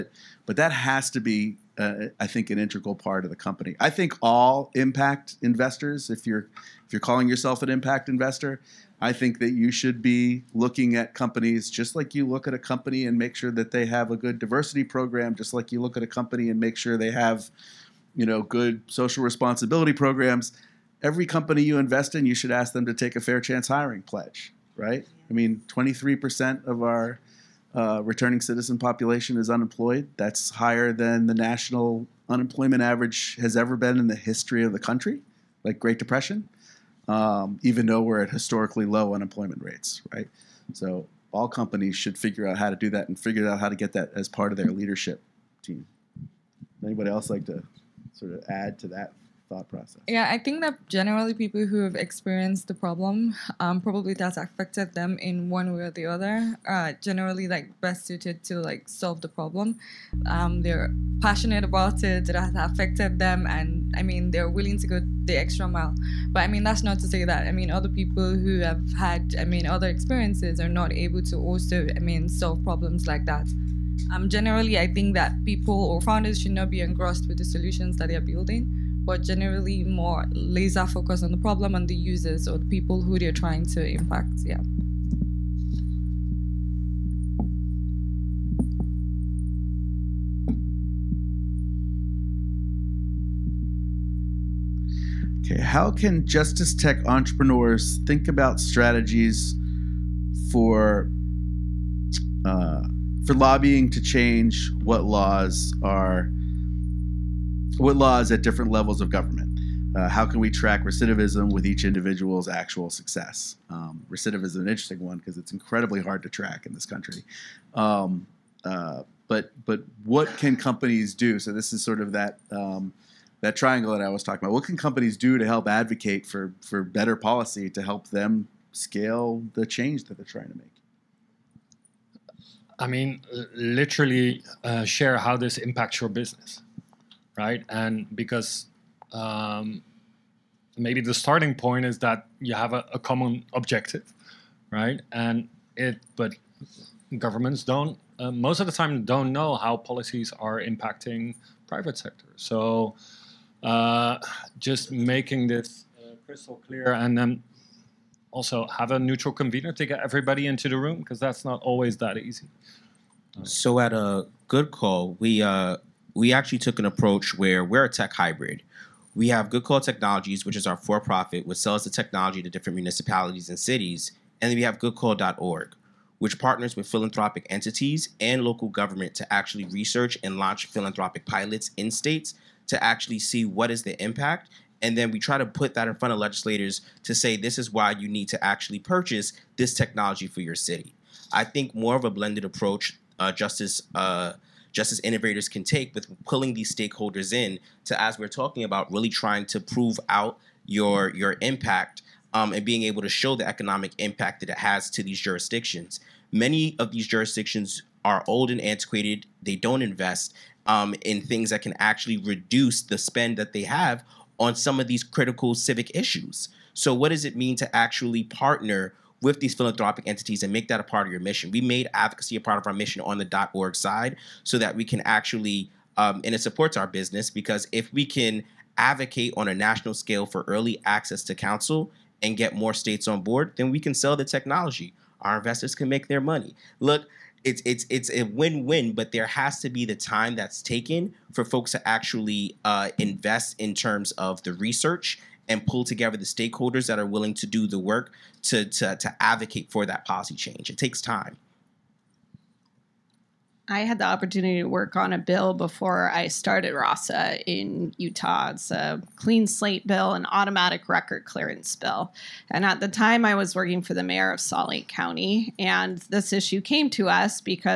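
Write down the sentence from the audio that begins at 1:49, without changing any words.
Uh, how can we track recidivism with each individual's actual success?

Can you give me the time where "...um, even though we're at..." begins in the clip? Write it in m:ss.
0:37.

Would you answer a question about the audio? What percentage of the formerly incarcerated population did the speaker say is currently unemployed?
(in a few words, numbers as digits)
23%.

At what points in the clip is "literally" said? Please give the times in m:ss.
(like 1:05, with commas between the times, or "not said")
2:13.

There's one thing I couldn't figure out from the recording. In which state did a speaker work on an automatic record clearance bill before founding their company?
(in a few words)
Utah.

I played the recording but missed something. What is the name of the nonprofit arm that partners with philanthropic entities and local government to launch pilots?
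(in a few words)
GoodCall.org.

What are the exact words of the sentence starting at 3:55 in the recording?
Our investors can make their money.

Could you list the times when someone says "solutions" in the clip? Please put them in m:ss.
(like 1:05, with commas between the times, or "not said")
1:17.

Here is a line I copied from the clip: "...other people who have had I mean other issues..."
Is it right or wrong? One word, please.
wrong.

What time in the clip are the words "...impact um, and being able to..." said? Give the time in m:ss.
3:21.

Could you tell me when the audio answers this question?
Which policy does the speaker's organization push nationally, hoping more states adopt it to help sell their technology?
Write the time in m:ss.
3:50.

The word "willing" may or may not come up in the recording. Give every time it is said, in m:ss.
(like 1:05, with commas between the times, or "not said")
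1:04, 4:07.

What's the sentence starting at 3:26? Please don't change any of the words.
Many of these jurisdictions are old and antiquated.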